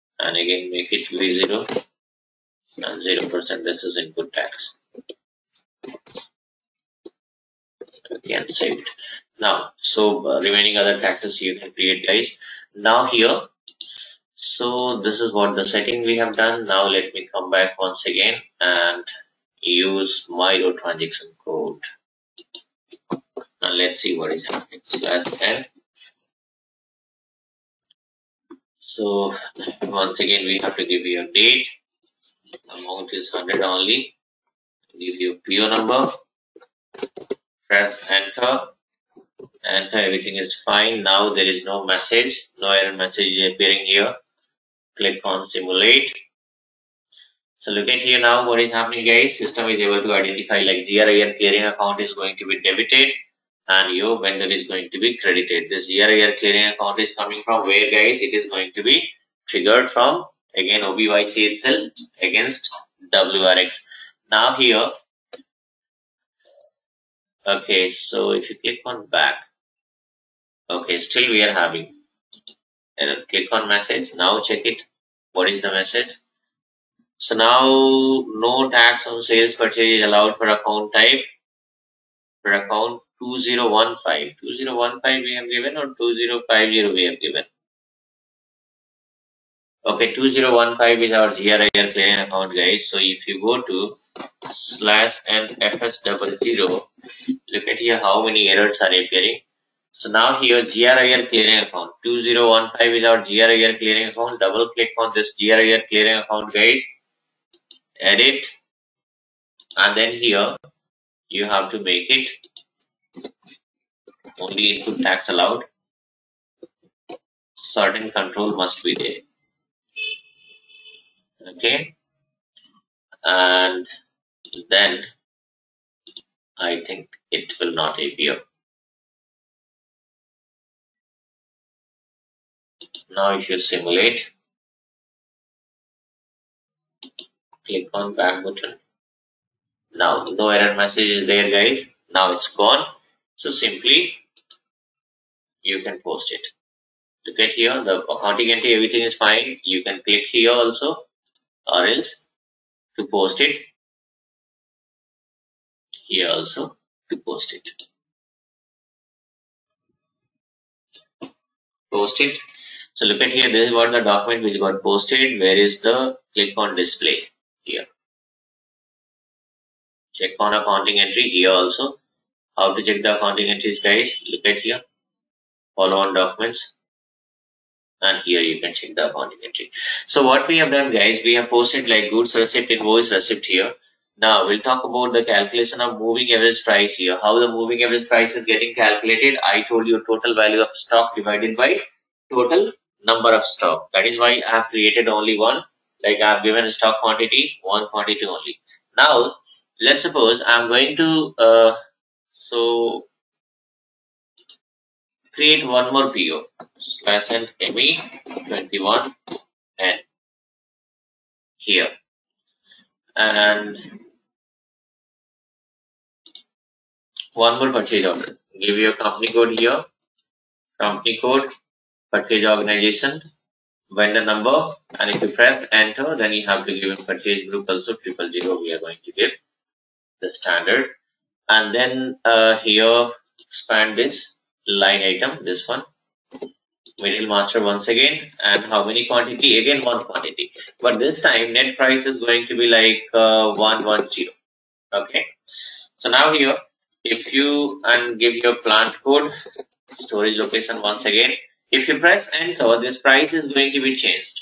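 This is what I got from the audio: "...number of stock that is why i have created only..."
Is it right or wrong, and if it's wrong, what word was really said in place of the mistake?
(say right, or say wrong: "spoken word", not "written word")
right.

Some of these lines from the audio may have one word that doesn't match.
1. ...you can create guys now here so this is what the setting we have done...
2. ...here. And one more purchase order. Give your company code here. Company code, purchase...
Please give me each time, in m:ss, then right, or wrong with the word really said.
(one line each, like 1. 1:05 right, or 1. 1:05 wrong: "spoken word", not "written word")
1. 0:11 right
2. 3:31 right.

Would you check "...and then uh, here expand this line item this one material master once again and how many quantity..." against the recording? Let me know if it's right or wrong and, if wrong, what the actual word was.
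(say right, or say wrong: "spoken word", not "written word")
right.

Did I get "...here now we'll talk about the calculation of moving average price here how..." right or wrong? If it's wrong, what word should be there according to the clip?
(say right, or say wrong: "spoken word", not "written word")
right.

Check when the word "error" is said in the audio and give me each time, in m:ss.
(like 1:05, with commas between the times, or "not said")
0:42, 1:12, 1:38, 2:20.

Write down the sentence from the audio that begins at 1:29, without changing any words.
Okay, 2015 is our GRIR clearing account guys.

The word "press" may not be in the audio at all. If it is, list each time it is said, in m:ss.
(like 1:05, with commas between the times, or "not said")
0:37, 3:45, 4:11.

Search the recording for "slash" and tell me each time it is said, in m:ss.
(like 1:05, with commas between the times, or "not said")
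0:24, 1:34, 3:27.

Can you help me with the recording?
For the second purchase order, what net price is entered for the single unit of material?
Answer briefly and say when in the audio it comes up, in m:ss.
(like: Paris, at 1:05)
110, at 4:03.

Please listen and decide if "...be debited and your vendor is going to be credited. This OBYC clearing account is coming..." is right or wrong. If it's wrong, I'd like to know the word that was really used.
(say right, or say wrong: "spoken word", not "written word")
wrong: "GRIR", not "OBYC".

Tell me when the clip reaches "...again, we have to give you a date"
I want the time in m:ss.
0:30.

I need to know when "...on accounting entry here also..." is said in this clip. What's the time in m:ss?
2:50.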